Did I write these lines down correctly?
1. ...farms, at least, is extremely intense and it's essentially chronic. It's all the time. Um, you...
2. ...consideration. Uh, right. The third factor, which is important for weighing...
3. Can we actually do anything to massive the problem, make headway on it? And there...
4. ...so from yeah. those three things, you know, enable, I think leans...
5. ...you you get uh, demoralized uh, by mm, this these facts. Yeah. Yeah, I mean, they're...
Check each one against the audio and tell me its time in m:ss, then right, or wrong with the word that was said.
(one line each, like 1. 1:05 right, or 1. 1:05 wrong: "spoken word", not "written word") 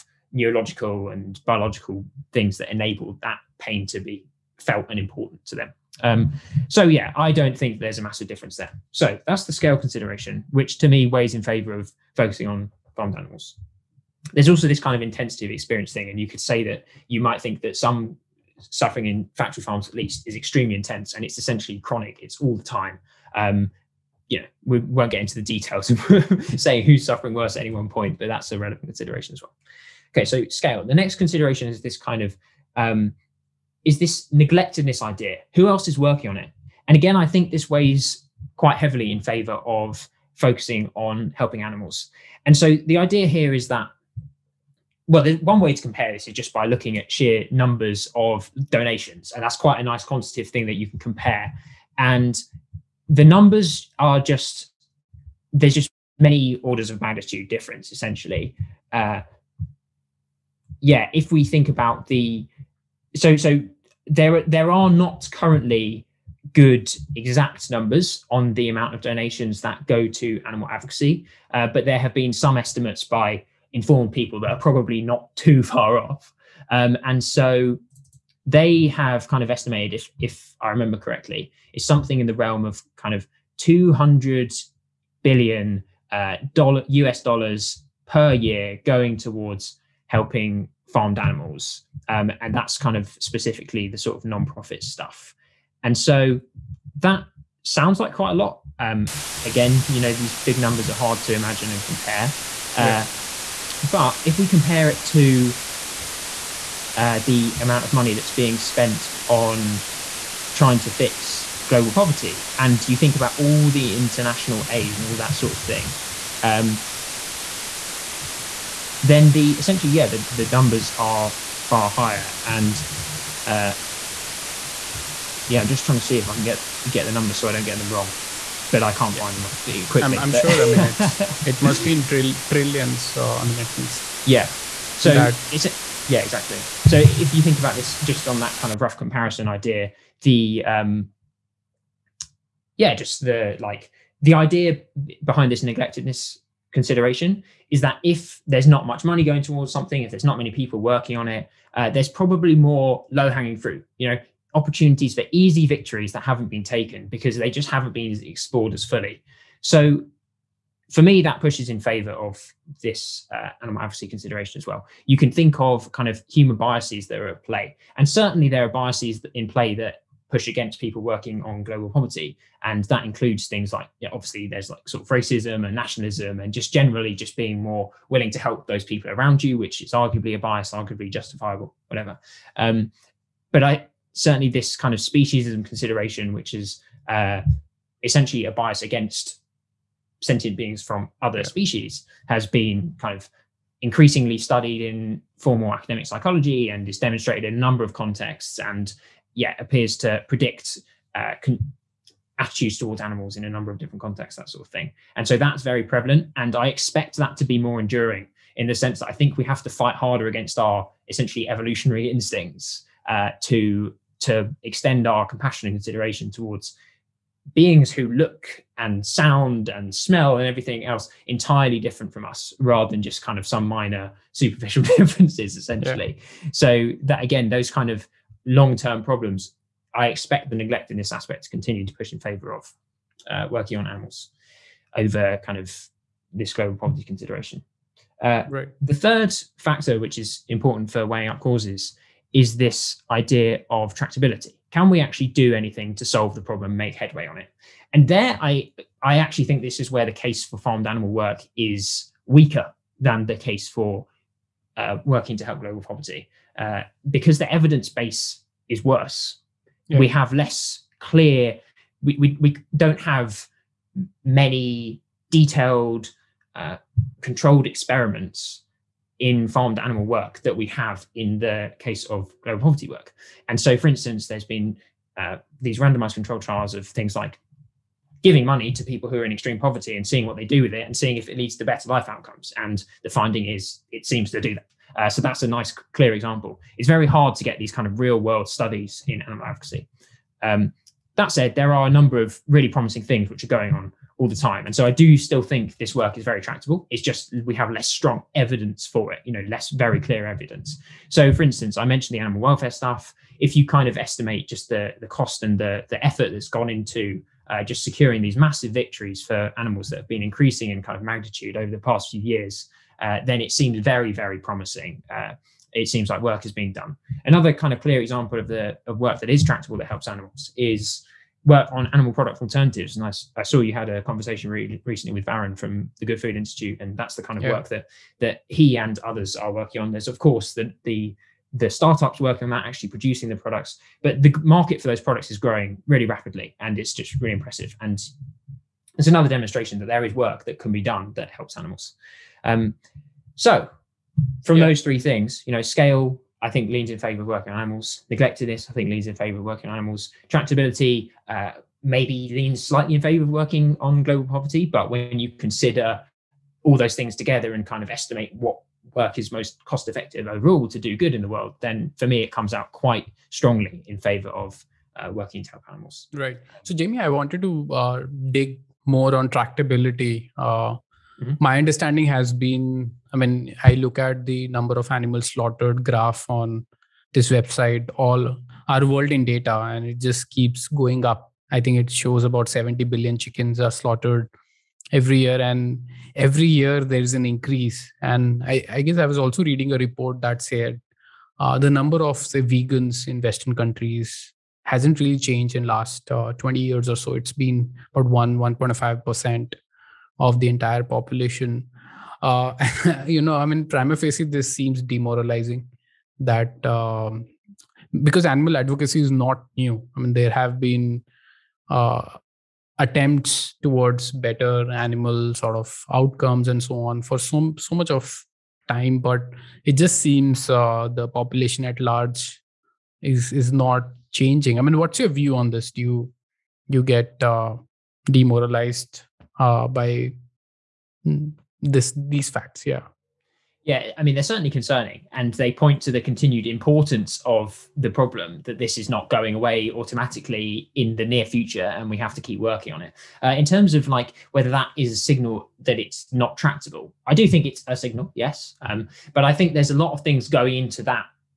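1. 0:19 right
2. 3:57 right
3. 4:04 wrong: "solve", not "massive"
4. 5:43 wrong: "scale", not "enable"
5. 7:05 right.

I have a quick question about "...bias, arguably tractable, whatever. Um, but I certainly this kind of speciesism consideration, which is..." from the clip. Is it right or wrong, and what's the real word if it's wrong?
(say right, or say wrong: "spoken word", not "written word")
wrong: "justifiable", not "tractable".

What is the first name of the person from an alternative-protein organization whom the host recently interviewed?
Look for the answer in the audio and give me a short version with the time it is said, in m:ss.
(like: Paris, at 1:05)
Varun, at 5:25.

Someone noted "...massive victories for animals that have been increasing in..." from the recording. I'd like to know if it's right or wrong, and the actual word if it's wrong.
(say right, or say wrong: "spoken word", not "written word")
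right.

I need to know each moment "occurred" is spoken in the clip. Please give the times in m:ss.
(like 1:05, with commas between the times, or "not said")
not said.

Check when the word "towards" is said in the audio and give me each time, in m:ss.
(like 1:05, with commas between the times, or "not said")
1:29, 2:29, 3:22, 3:36, 6:53.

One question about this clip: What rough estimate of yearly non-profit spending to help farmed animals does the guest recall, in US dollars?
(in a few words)
200 billion.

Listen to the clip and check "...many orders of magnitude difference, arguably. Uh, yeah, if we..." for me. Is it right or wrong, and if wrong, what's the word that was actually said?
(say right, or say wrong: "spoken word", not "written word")
wrong: "essentially", not "arguably".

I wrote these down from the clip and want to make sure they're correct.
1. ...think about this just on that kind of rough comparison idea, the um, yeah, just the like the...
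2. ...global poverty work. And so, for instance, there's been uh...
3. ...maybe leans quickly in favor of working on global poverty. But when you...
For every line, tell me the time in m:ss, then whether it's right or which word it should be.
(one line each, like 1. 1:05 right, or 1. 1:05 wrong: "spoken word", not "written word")
1. 2:17 right
2. 4:32 right
3. 5:51 wrong: "slightly", not "quickly".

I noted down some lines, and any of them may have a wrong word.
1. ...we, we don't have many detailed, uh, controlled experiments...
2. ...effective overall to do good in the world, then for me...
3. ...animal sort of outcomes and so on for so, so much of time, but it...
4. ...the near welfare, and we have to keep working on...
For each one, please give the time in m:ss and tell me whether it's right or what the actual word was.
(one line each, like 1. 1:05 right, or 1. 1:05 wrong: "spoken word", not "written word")
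1. 4:22 right
2. 5:59 right
3. 6:54 right
4. 7:20 wrong: "future", not "welfare".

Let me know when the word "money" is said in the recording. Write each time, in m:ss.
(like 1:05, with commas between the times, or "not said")
1:47, 2:29, 4:38.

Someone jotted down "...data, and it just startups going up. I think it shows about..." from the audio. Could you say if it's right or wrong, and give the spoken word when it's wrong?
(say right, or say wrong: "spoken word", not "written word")
wrong: "keeps", not "startups".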